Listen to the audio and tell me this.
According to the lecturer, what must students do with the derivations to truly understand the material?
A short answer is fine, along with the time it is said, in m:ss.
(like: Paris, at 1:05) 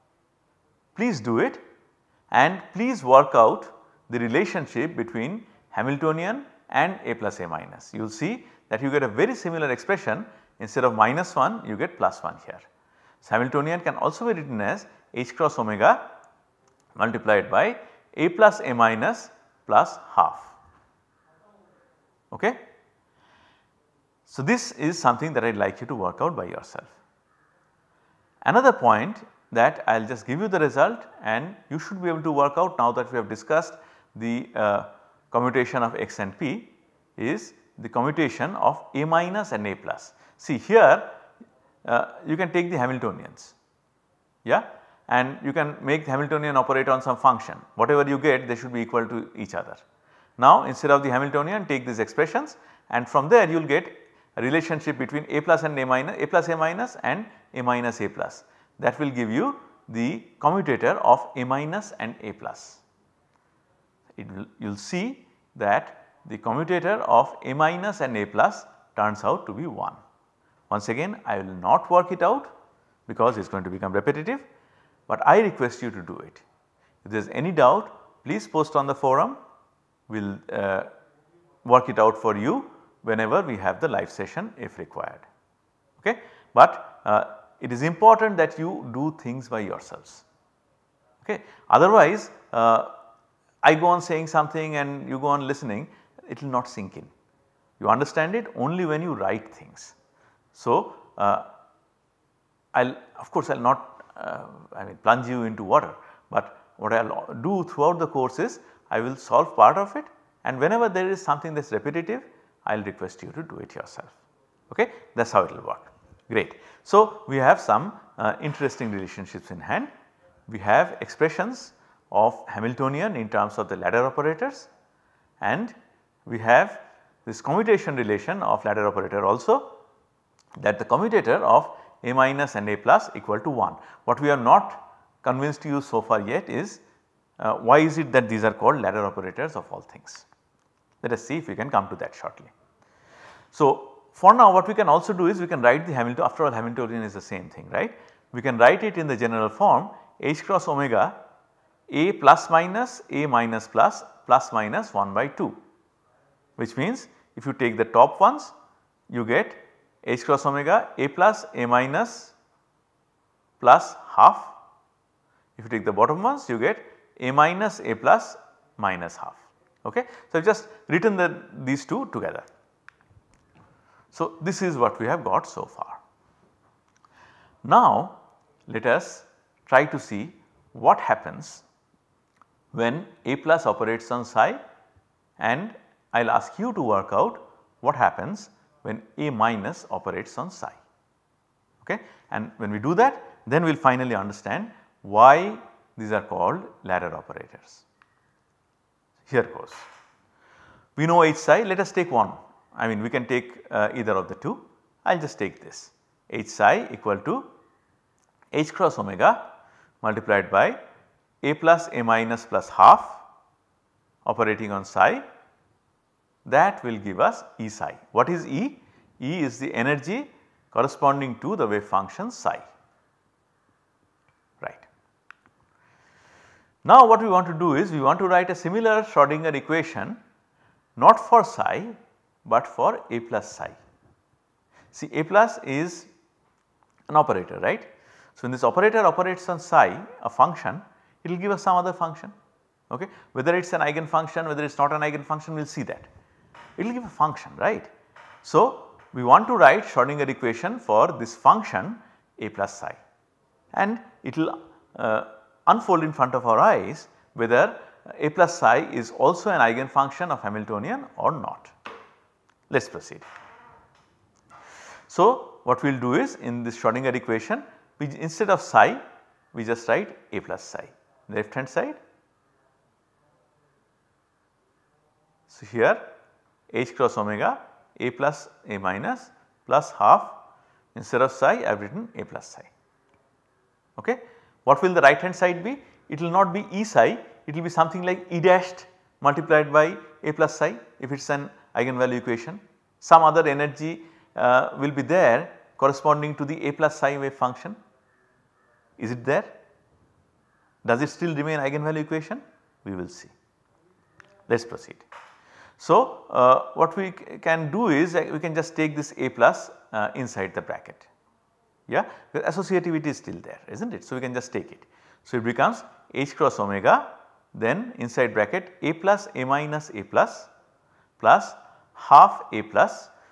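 Write things, at 1:39.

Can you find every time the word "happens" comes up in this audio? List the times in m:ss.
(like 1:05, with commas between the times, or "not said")
3:01, 3:07.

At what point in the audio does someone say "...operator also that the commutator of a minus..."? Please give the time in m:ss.
2:08.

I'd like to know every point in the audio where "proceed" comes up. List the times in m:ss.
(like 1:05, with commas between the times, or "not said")
4:22, 5:04.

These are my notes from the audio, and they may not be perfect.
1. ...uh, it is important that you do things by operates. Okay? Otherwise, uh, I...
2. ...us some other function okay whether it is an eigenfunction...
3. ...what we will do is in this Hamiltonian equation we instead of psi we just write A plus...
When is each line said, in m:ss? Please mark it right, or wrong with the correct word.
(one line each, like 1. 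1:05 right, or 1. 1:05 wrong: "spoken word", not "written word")
1. 1:27 wrong: "yourselves", not "operates"
2. 4:01 right
3. 4:25 wrong: "Schrodinger", not "Hamiltonian".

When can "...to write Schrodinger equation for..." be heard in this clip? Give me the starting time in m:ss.
4:09.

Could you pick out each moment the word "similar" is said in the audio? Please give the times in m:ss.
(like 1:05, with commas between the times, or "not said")
0:09, 3:48.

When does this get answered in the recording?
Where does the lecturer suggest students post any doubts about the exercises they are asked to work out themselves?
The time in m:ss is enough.
1:18.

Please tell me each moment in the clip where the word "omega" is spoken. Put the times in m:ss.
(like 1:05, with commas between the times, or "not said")
0:15, 2:30, 2:40, 3:29, 4:37, 5:16.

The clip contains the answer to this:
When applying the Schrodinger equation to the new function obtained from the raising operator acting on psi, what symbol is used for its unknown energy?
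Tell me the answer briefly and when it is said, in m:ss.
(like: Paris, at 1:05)
E dashed, at 4:48.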